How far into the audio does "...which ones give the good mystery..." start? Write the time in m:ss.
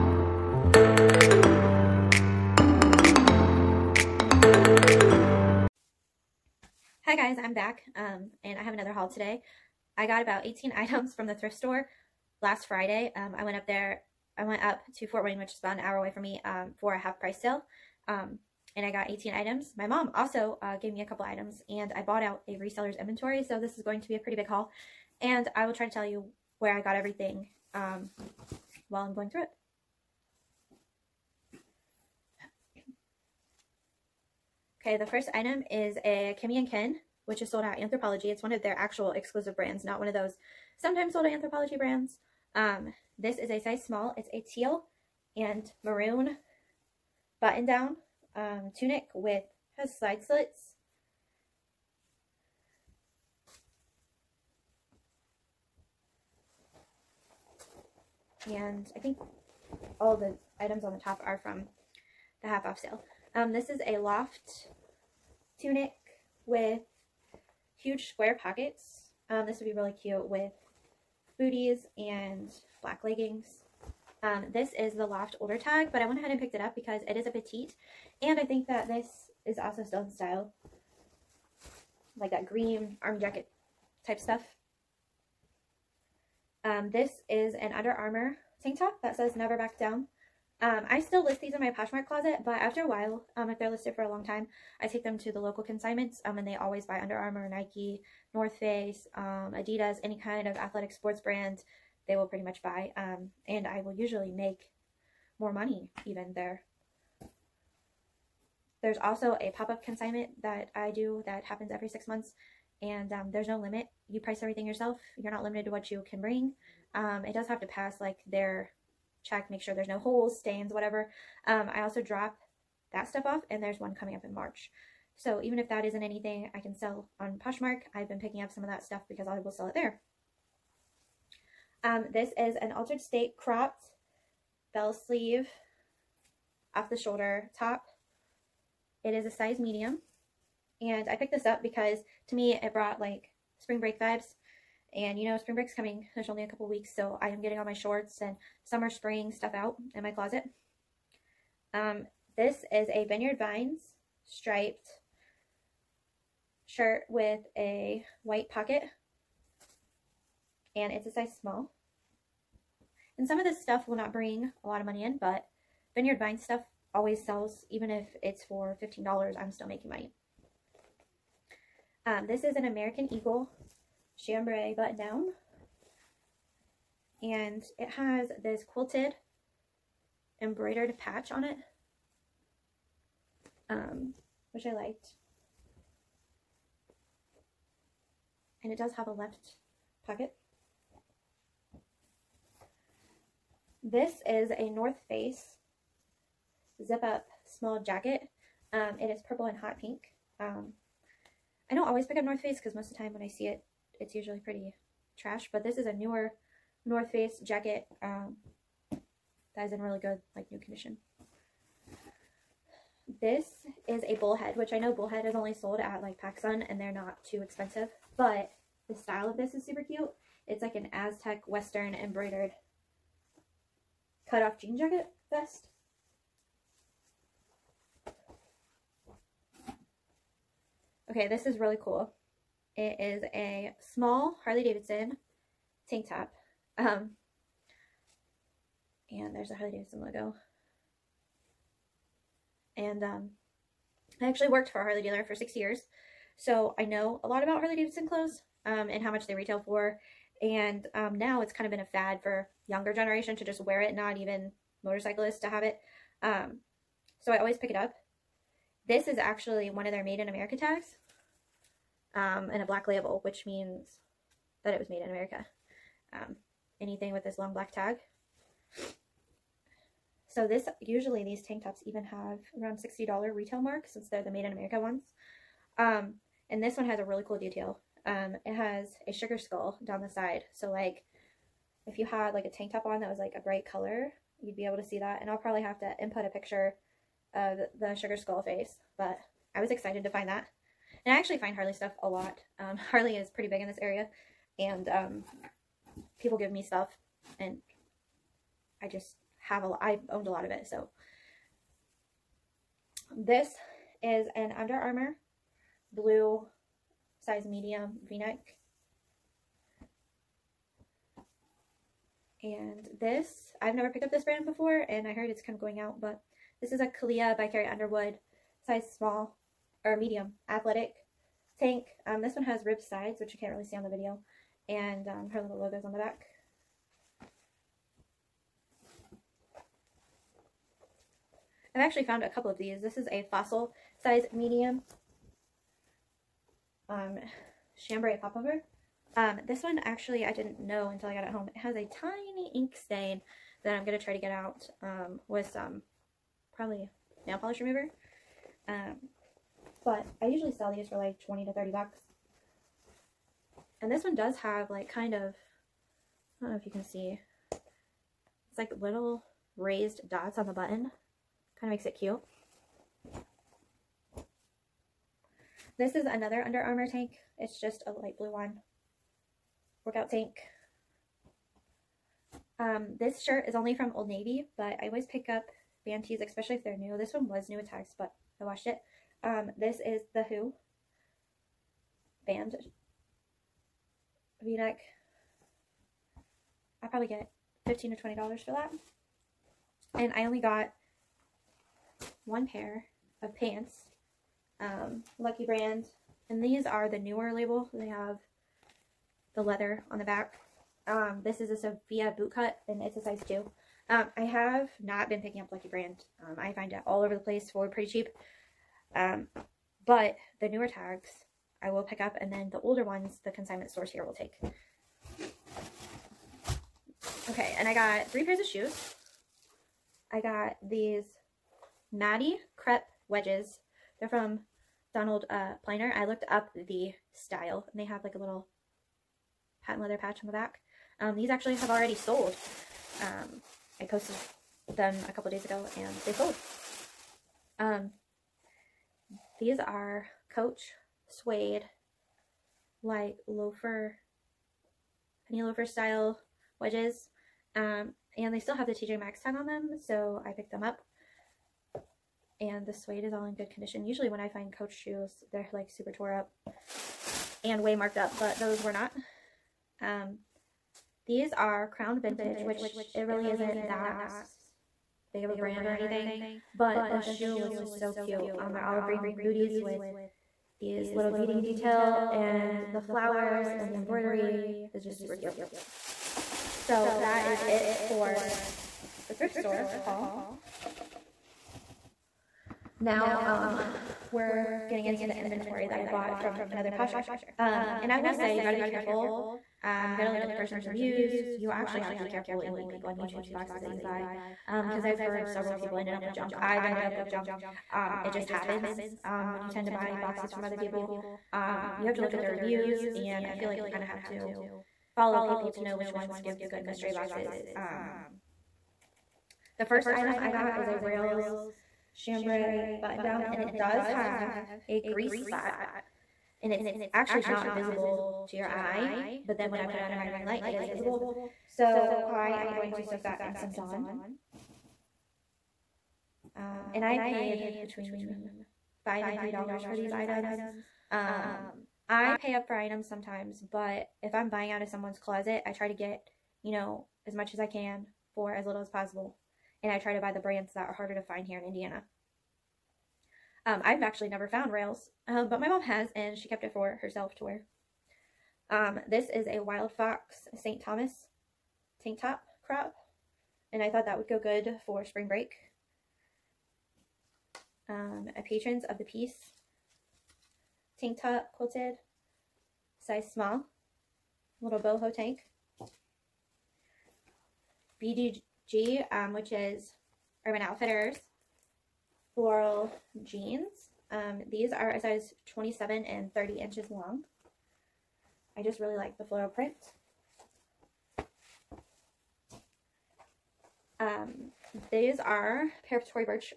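8:25.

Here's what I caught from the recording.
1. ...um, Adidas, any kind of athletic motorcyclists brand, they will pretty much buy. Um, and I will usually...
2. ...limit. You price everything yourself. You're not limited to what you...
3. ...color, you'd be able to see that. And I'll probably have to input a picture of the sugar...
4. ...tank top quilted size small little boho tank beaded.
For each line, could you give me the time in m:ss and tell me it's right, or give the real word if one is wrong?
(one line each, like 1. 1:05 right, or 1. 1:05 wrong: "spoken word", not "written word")
1. 1:39 wrong: "sports", not "motorcyclists"
2. 1:53 right
3. 4:43 right
4. 9:20 right.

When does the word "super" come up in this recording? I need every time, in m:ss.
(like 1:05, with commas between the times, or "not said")
3:39, 7:35, 7:55.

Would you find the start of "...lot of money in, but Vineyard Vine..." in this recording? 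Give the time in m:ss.
2:44.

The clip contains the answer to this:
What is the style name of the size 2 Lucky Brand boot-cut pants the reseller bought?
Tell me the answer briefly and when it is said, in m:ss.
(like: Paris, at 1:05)
Sophia, at 6:41.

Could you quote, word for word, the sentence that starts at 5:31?
I've actually found a couple of these.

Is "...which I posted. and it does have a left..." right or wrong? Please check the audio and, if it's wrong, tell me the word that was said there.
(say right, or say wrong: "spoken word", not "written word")
wrong: "liked", not "posted".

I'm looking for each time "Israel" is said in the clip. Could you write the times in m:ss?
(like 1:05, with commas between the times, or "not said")
not said.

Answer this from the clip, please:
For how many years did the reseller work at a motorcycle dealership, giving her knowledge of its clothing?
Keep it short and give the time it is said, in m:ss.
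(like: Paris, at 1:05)
6, at 4:05.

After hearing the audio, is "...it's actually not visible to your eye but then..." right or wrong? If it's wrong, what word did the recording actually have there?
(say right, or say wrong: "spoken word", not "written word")
right.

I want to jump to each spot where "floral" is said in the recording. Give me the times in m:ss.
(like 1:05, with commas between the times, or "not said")
9:32, 9:39.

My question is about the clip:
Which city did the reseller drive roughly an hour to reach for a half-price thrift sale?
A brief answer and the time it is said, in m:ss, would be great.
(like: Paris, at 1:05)
Fort Wayne, at 0:15.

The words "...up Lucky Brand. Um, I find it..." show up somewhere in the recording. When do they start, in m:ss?
6:45.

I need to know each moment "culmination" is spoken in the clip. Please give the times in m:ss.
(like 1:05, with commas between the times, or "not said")
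not said.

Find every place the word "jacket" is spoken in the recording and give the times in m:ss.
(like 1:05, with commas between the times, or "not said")
1:23, 3:17, 3:27, 3:44.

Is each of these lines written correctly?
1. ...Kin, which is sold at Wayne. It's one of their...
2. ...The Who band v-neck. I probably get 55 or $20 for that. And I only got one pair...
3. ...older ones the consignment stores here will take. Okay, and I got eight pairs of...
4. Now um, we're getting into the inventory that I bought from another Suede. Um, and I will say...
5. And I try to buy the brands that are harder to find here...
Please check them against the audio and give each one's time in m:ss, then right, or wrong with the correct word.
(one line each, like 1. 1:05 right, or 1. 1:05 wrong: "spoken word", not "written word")
1. 0:36 wrong: "Anthropologie", not "Wayne"
2. 6:20 wrong: "15", not "55"
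3. 6:52 wrong: "three", not "eight"
4. 8:02 wrong: "Posher", not "Suede"
5. 8:59 right.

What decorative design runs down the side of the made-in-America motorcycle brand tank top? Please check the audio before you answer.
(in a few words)
a sugar skull.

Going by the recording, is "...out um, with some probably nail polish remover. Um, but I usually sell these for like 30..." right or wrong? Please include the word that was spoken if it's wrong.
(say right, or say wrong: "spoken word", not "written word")
wrong: "20", not "30".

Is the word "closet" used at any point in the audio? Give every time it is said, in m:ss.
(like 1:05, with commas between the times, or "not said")
1:32, 2:30, 8:54.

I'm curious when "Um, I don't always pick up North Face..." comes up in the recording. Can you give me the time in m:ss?
3:20.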